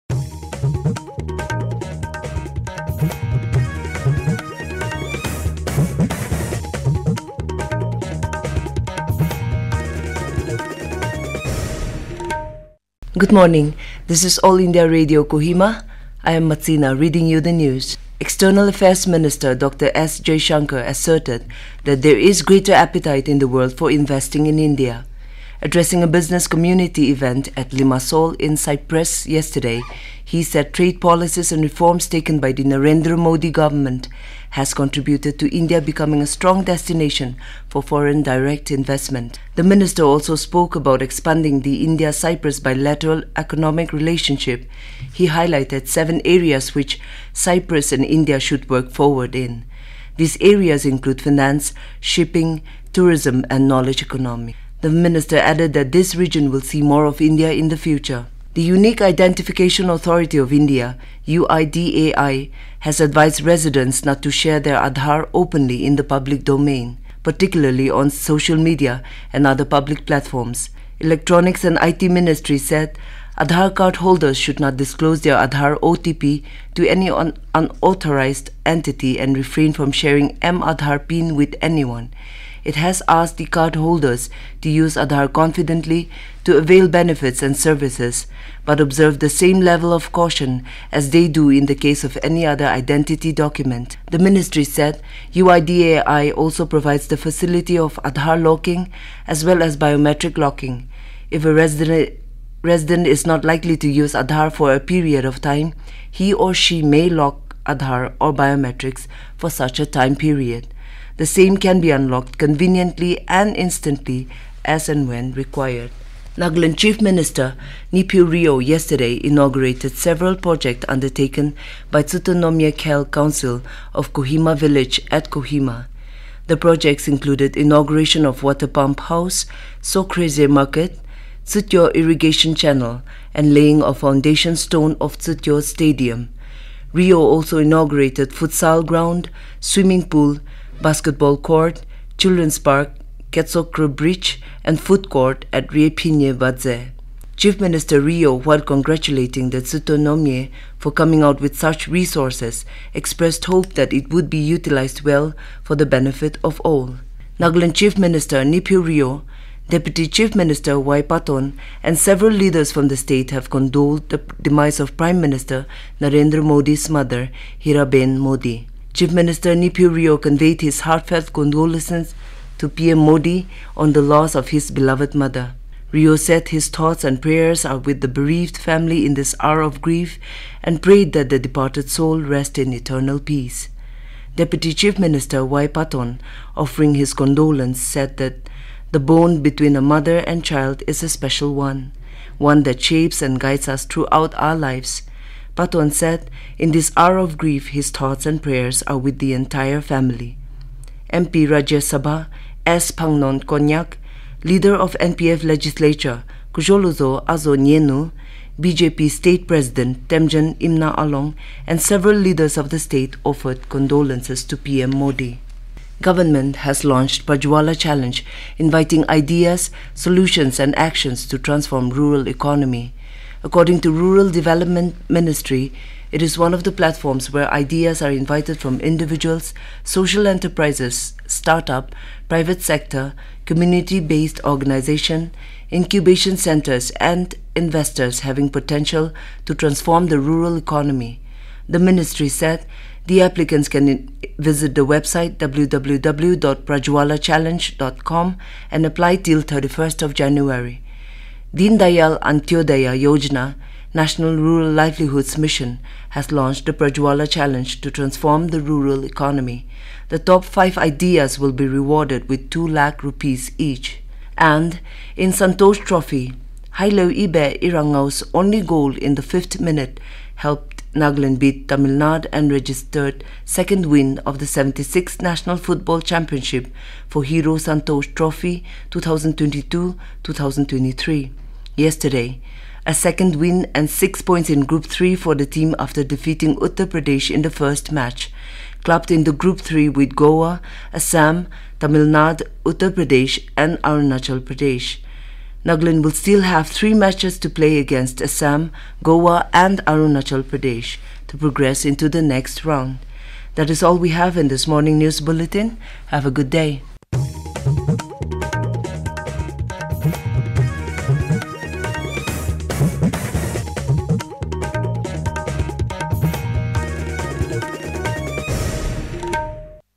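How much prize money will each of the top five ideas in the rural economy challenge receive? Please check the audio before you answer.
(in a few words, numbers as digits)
2 lakh rupees.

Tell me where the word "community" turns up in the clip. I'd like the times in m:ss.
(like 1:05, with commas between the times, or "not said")
0:26, 3:53.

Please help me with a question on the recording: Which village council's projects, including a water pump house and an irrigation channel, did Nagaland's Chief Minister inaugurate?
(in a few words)
Kohima Village.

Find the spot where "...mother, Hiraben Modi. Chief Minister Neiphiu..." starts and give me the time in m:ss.
2:46.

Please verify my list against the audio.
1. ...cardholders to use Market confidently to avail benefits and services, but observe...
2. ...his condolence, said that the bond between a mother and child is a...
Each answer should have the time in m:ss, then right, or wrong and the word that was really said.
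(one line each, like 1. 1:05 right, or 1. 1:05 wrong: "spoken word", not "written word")
1. 1:23 wrong: "Aadhaar", not "Market"
2. 3:06 right.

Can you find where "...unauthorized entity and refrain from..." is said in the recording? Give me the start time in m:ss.
1:17.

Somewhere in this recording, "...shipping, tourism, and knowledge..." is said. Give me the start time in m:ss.
0:52.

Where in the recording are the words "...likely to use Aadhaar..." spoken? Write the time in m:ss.
1:43.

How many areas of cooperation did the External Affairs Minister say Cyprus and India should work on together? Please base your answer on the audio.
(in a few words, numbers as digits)
7.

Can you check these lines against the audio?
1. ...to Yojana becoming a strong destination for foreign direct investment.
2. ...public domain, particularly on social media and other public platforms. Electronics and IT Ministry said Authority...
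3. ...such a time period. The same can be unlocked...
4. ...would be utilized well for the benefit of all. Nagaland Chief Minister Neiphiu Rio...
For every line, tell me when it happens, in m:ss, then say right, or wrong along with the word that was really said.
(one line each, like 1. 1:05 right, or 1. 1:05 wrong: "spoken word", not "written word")
1. 0:35 wrong: "India", not "Yojana"
2. 1:06 wrong: "Aadhaar", not "Authority"
3. 1:49 right
4. 2:34 right.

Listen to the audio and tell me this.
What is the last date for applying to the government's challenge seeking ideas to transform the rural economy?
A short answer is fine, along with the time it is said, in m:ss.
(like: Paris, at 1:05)
31 January, at 4:09.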